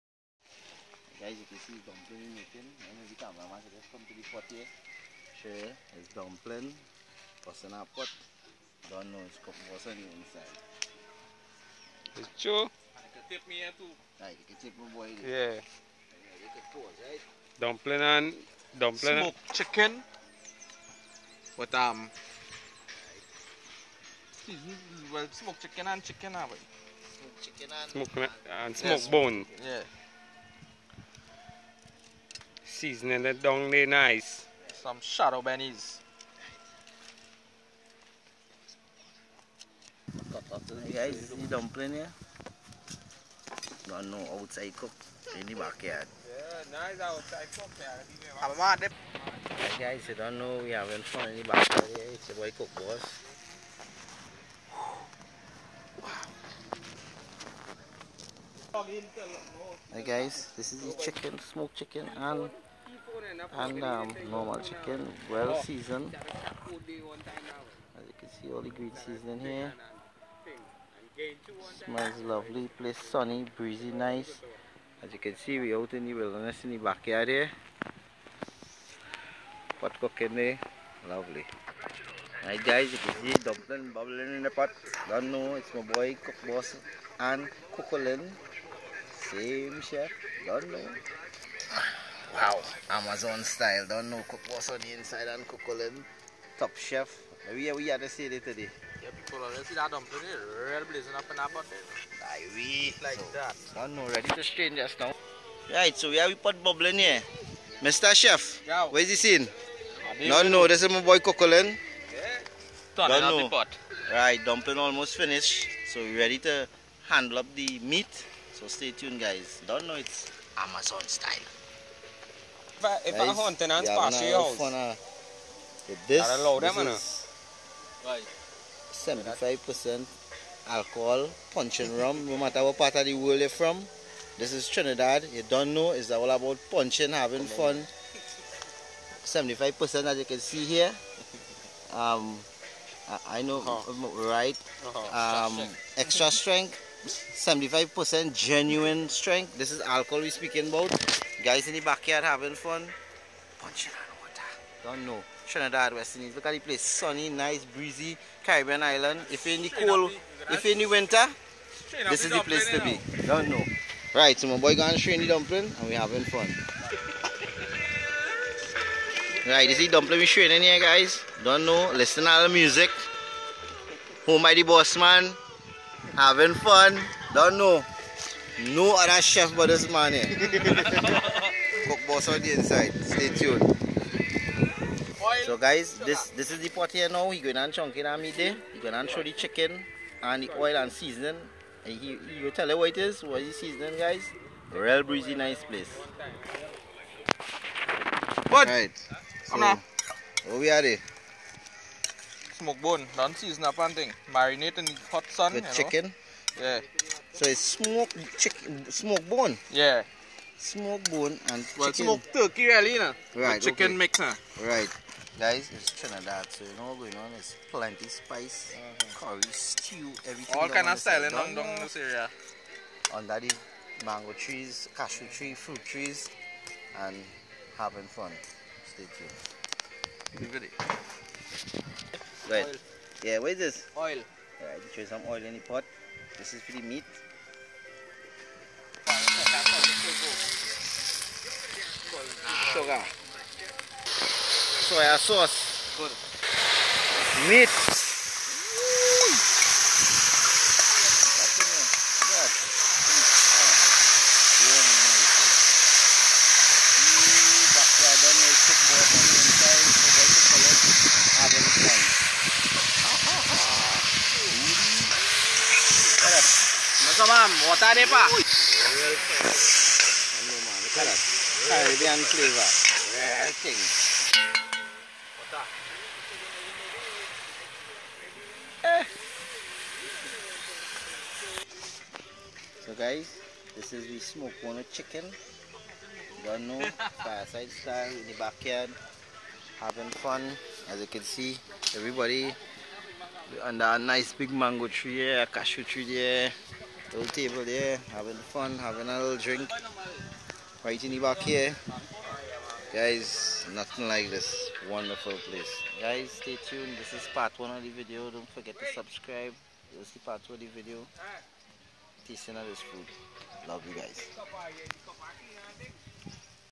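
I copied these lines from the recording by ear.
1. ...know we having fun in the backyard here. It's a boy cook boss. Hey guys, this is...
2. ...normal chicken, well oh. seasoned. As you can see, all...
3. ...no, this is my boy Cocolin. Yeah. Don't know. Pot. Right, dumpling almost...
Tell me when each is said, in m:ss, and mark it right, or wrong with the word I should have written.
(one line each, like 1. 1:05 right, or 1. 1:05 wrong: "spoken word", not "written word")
1. 0:50 right
2. 1:04 right
3. 1:50 right.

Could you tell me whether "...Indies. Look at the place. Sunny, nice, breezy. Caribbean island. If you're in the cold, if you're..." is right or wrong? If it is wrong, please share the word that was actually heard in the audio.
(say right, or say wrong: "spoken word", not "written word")
right.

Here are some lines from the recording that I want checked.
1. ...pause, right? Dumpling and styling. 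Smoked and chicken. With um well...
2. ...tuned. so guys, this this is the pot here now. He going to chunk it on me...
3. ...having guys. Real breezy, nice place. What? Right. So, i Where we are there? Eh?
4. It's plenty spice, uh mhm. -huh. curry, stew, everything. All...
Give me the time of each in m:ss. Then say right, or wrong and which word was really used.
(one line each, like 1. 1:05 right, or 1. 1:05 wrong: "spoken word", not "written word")
1. 0:16 wrong: "dumpling", not "styling"
2. 3:03 right
3. 3:13 wrong: "seasoning", not "having"
4. 3:37 right.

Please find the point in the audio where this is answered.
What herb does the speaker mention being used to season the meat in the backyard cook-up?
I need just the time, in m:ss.
0:35.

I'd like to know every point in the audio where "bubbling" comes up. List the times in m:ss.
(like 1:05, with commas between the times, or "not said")
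1:23, 1:46.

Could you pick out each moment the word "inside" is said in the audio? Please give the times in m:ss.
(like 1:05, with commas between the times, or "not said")
0:10, 1:34, 3:02.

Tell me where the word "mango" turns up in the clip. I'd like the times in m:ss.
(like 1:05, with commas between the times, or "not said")
3:44, 4:54.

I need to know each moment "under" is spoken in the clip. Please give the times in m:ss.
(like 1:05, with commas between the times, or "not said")
3:43, 4:53.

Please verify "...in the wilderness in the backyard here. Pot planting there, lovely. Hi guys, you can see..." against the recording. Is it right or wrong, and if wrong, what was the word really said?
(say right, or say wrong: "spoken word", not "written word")
wrong: "cooking", not "planting".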